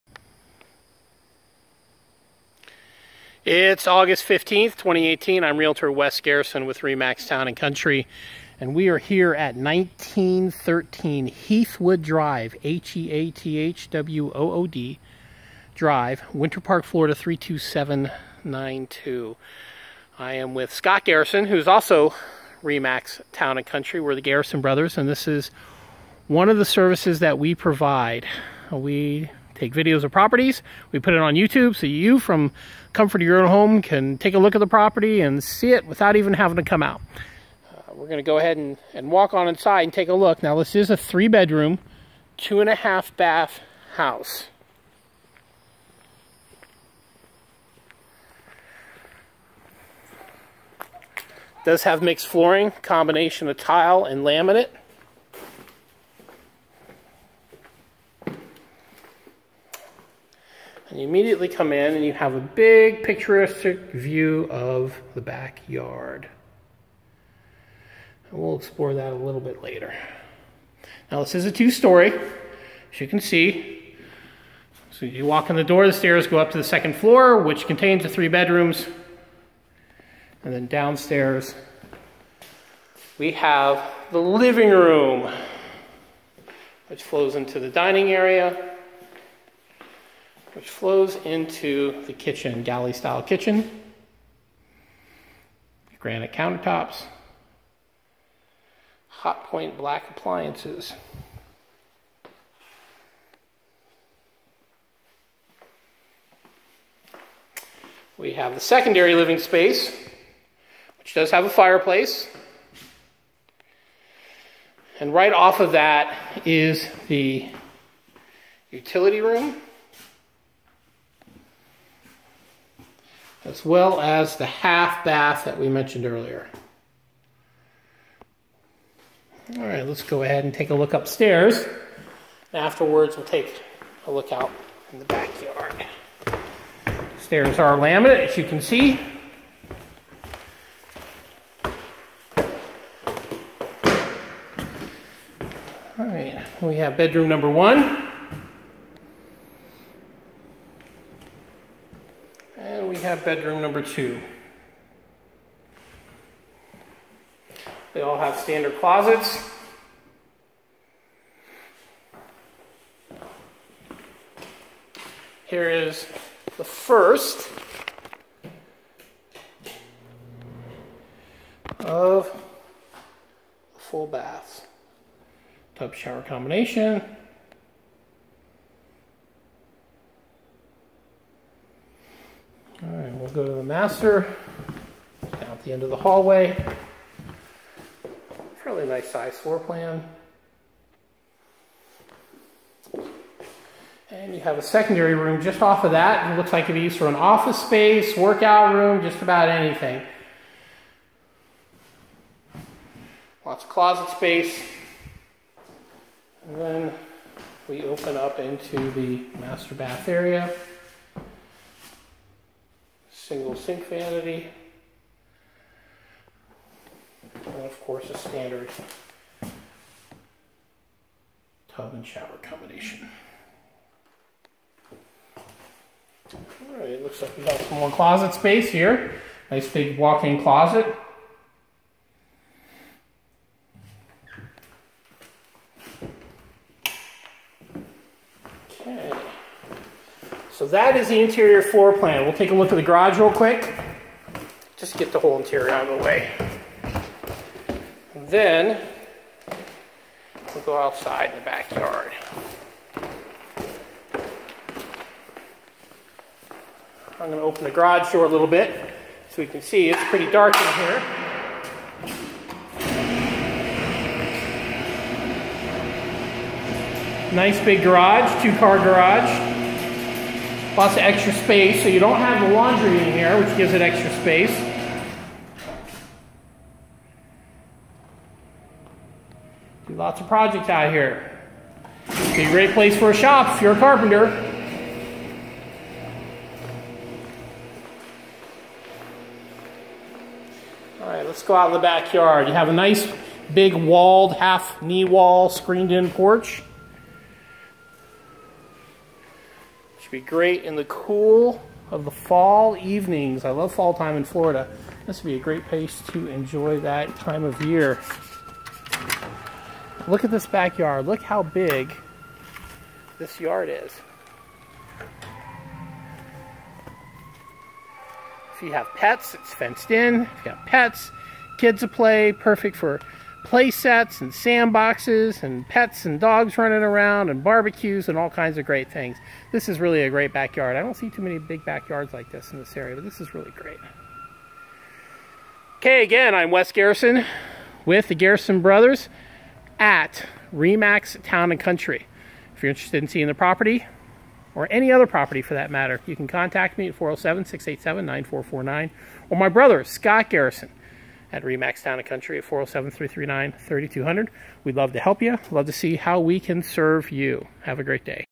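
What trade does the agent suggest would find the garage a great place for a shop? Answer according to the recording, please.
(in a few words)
Carpenter.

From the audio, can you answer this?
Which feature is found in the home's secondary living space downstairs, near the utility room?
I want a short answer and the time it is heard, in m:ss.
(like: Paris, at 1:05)
A fireplace, at 1:51.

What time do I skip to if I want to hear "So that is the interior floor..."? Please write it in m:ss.
4:00.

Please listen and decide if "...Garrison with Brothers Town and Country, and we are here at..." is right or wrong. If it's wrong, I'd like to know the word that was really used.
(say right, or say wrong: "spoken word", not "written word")
wrong: "Remax", not "Brothers".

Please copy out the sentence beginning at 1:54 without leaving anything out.
And right off of that is the utility room.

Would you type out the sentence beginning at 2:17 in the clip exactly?
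Stairs are laminate, as you can see.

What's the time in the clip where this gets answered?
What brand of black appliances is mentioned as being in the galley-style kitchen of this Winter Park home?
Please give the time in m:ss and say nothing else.
1:39.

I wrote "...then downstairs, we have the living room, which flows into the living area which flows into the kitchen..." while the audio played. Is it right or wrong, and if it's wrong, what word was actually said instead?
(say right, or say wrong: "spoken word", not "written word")
wrong: "dining", not "living".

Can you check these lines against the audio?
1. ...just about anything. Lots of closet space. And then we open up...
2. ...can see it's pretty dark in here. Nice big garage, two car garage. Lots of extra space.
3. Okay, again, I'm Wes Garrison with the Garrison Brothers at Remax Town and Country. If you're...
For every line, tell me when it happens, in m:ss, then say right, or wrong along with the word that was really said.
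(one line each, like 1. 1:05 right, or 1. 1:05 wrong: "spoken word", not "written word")
1. 3:19 right
2. 4:19 right
3. 5:35 right.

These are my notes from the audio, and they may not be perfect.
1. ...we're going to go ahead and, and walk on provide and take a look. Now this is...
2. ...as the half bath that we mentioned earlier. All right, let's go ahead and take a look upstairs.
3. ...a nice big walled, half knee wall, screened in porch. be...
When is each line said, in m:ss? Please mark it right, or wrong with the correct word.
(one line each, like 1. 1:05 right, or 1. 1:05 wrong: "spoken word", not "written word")
1. 0:37 wrong: "inside", not "provide"
2. 2:03 right
3. 4:52 right.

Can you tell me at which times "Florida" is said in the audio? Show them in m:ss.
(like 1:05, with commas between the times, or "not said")
0:16, 5:04.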